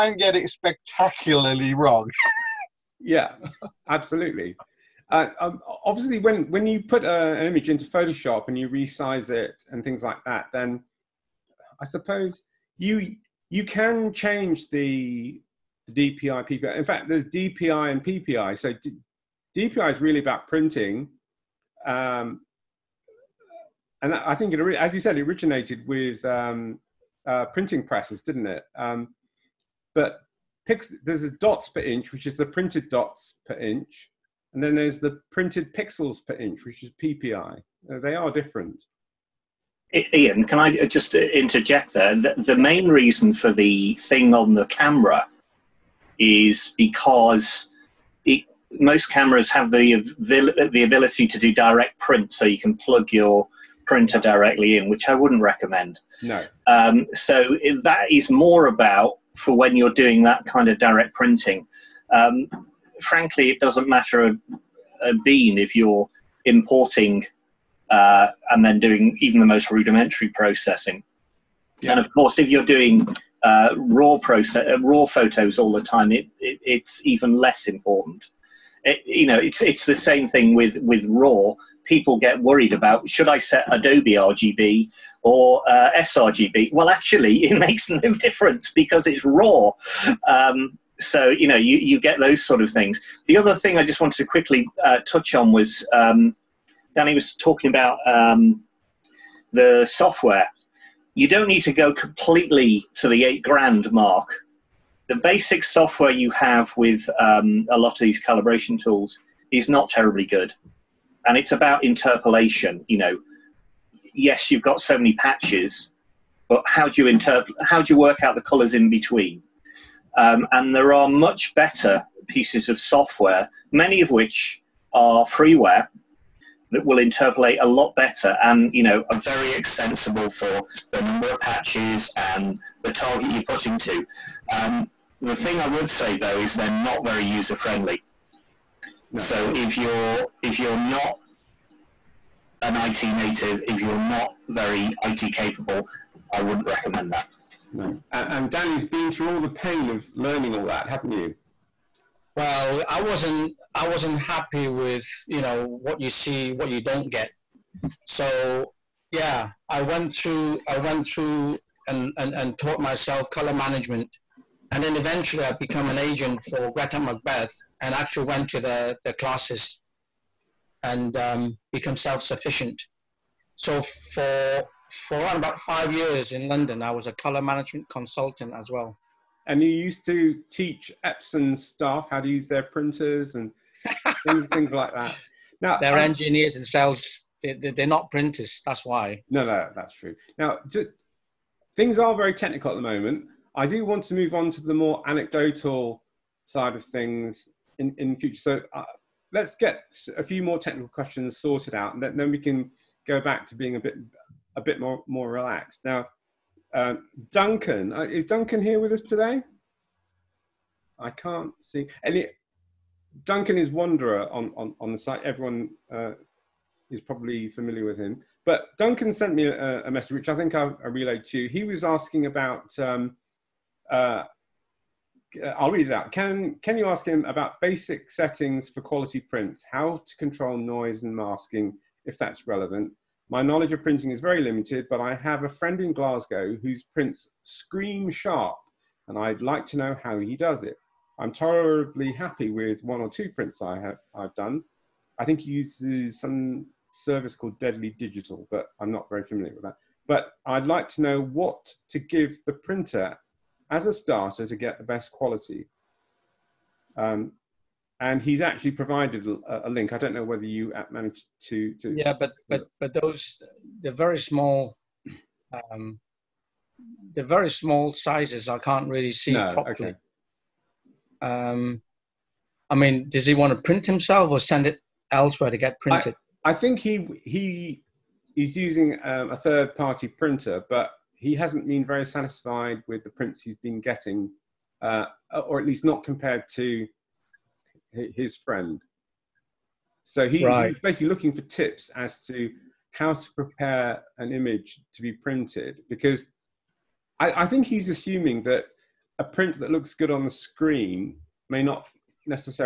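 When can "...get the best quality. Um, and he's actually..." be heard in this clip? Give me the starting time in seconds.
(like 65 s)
254 s.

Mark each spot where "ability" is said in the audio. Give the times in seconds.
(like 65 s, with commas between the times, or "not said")
50 s.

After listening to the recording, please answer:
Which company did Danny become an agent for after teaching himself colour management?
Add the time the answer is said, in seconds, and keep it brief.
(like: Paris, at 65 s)
GretagMacbeth, at 166 s.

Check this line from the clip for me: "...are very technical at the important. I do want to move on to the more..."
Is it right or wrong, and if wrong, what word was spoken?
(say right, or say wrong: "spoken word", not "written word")
wrong: "moment", not "important".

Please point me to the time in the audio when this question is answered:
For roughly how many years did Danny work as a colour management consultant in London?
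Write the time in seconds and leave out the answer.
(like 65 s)
175 s.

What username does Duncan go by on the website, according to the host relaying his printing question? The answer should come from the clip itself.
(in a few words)
Wanderer.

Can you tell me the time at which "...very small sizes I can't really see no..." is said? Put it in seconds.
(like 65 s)
267 s.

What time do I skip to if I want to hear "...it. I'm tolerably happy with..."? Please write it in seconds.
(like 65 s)
240 s.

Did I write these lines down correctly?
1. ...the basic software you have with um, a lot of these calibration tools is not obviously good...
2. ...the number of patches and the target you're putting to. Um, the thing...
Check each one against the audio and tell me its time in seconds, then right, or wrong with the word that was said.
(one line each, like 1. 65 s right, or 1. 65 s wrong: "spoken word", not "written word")
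1. 105 s wrong: "terribly", not "obviously"
2. 130 s right.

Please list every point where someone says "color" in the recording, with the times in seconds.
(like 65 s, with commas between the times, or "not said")
118 s, 163 s, 177 s.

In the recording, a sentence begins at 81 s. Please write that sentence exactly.
People get worried about should I set Adobe RGB or uh, sRGB?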